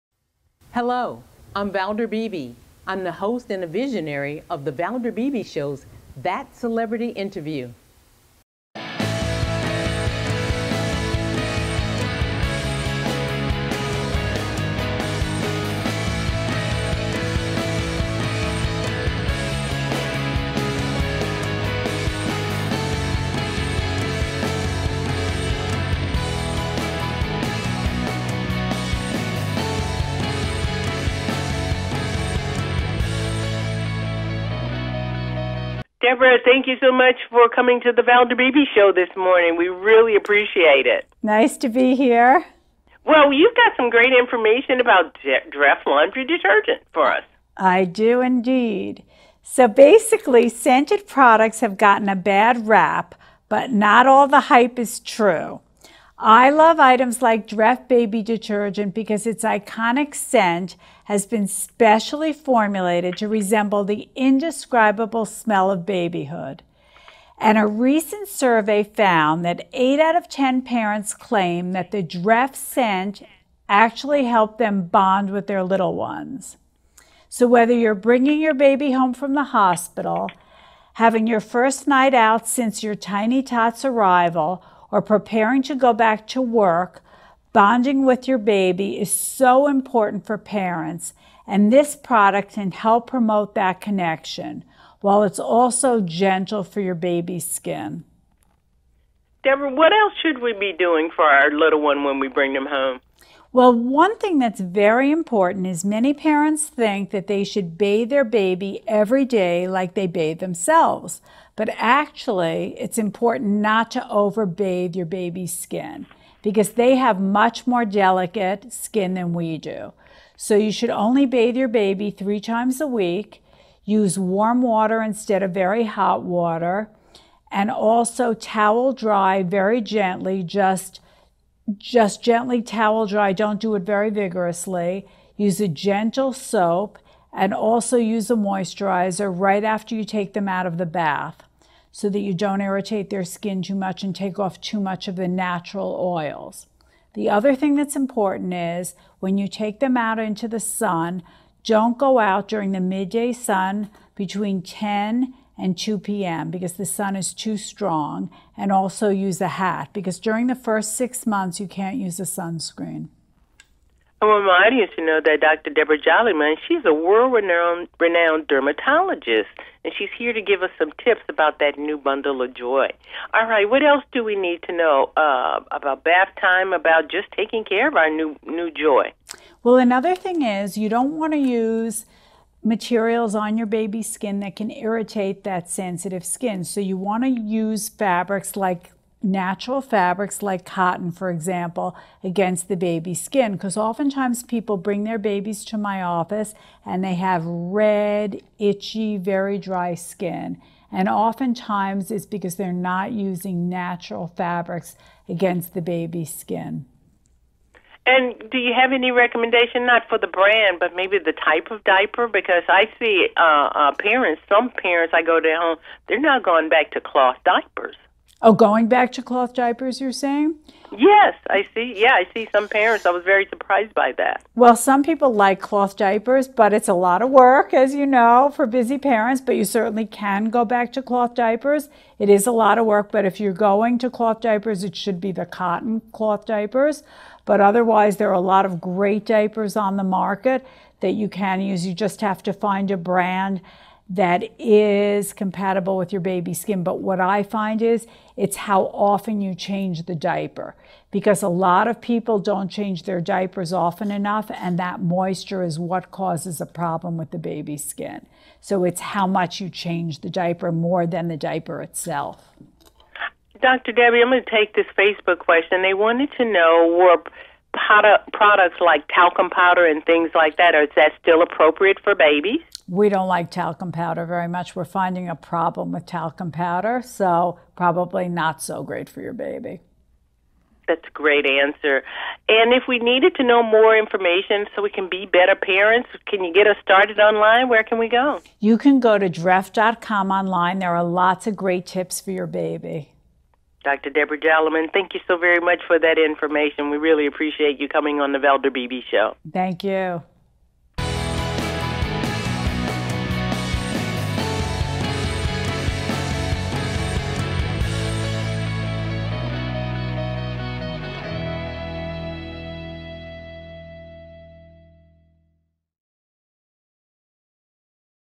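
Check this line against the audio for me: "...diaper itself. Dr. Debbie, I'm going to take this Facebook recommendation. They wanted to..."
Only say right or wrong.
wrong.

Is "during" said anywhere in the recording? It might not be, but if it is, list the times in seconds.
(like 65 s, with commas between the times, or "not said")
152 s, 160 s.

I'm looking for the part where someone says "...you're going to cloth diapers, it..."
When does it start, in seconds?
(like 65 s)
233 s.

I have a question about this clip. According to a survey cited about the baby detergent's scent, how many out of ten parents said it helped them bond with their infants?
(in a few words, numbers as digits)
8.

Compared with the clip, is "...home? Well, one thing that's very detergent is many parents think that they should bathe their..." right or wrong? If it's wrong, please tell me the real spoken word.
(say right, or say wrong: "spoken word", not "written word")
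wrong: "important", not "detergent".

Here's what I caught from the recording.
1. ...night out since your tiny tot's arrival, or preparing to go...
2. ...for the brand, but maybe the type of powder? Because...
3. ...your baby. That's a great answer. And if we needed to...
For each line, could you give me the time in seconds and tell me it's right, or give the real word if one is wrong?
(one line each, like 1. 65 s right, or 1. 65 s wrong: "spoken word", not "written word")
1. 81 s right
2. 210 s wrong: "diaper", not "powder"
3. 279 s right.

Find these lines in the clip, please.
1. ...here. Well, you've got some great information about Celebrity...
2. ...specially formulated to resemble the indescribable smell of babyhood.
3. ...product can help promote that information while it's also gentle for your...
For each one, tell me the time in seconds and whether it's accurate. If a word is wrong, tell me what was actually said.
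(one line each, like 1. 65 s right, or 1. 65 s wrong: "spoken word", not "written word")
1. 41 s wrong: "Dreft", not "Celebrity"
2. 61 s right
3. 91 s wrong: "connection", not "information".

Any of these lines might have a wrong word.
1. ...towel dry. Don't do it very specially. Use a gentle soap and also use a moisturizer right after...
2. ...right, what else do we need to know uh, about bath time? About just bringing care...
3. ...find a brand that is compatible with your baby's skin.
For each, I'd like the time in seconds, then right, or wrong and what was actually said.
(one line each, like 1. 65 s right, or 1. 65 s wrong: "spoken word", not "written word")
1. 132 s wrong: "vigorously", not "specially"
2. 173 s wrong: "taking", not "bringing"
3. 242 s right.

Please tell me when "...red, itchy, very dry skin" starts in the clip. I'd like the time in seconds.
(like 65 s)
197 s.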